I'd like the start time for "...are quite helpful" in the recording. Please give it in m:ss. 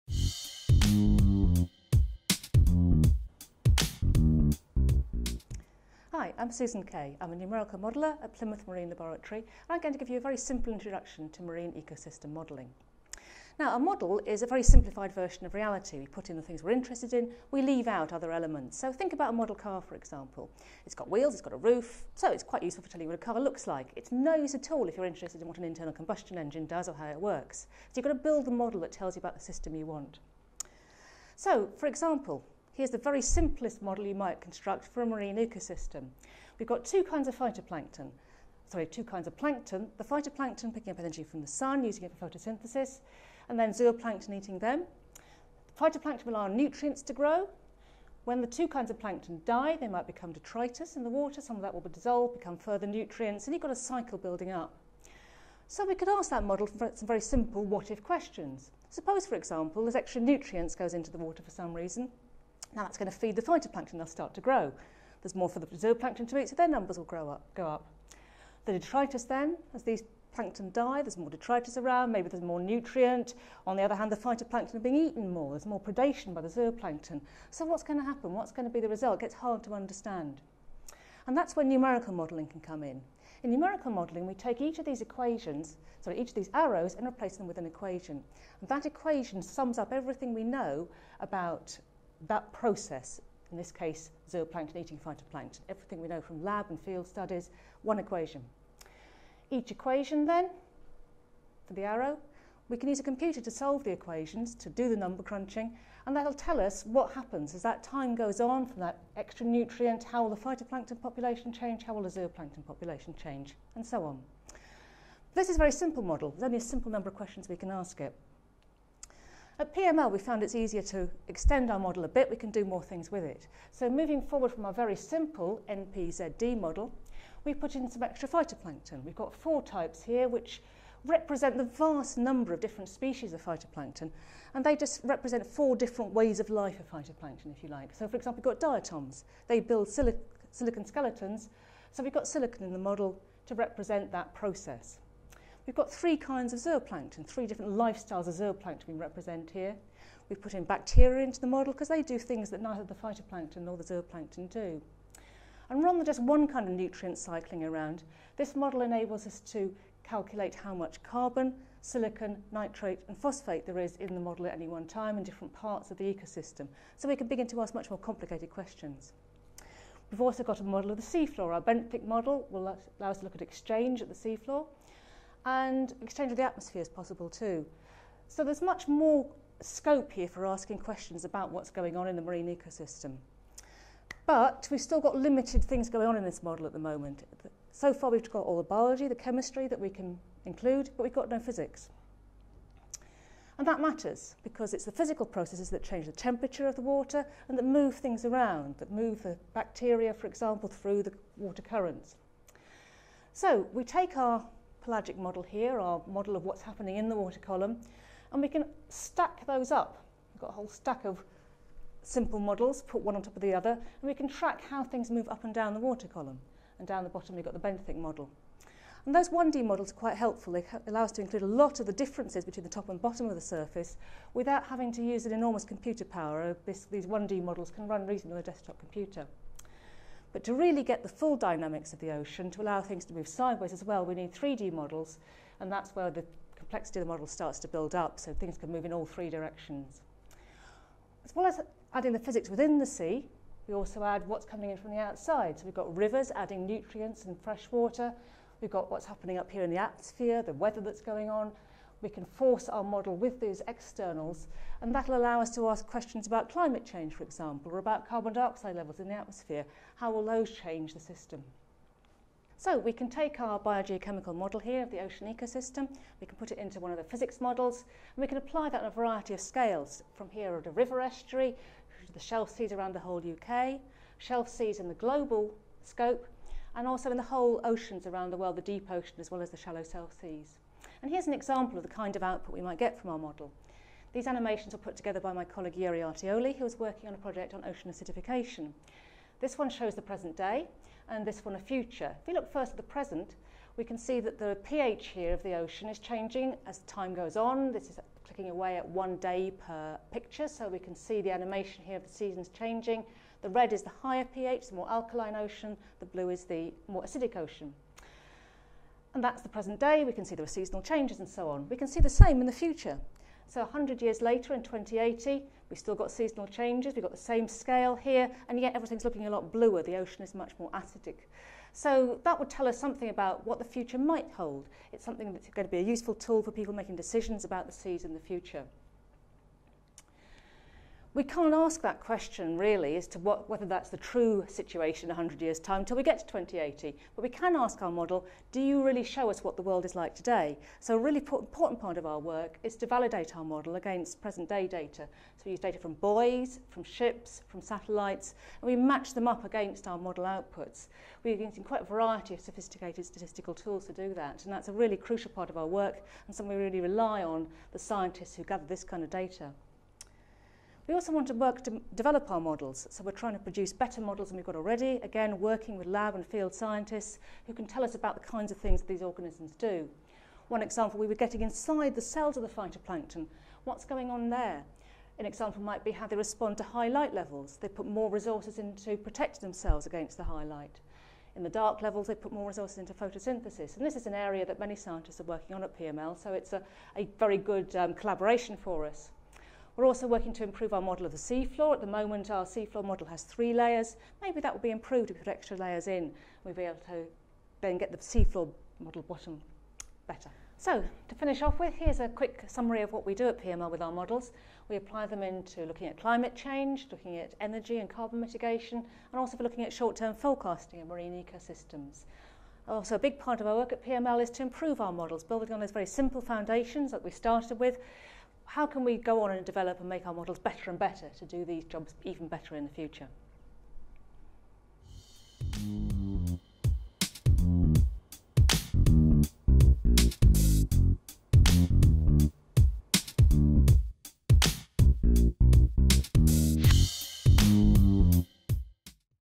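3:39.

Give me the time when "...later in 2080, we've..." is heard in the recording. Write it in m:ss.
5:14.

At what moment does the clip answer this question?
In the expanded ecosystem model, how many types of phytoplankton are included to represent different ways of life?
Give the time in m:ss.
2:09.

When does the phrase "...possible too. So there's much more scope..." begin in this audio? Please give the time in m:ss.
2:56.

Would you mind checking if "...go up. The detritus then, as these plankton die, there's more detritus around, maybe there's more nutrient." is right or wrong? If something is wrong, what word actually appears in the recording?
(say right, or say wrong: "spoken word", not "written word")
right.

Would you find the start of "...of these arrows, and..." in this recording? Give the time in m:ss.
1:26.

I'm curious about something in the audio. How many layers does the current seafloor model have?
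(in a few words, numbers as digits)
3.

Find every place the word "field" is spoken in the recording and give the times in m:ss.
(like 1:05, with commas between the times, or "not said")
1:36, 6:06.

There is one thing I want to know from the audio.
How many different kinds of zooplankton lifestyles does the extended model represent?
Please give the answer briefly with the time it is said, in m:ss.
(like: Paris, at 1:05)
3, at 2:25.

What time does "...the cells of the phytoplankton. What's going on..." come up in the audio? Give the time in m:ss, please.
6:11.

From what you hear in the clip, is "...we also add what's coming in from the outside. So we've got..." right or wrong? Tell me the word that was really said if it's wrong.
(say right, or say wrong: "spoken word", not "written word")
right.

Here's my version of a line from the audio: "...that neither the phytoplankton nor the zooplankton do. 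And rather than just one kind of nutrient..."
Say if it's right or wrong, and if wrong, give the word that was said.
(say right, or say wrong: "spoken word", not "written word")
right.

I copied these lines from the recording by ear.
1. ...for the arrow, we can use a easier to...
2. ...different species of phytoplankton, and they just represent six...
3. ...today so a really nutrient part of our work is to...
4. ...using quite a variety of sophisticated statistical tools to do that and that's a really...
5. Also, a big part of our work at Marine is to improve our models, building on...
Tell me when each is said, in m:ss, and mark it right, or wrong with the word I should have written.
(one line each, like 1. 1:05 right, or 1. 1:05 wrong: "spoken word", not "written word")
1. 1:41 wrong: "computer", not "easier"
2. 2:12 wrong: "four", not "six"
3. 5:40 wrong: "important", not "nutrient"
4. 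5:51 right
5. 6:52 wrong: "PML", not "Marine".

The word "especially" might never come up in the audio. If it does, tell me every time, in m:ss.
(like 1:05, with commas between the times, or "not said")
not said.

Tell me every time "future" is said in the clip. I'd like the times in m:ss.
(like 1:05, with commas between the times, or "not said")
4:51, 5:12, 5:23, 5:28, 7:02.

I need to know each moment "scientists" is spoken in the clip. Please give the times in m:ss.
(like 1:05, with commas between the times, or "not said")
5:57, 6:06, 6:24.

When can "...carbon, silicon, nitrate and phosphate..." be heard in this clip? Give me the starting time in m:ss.
2:41.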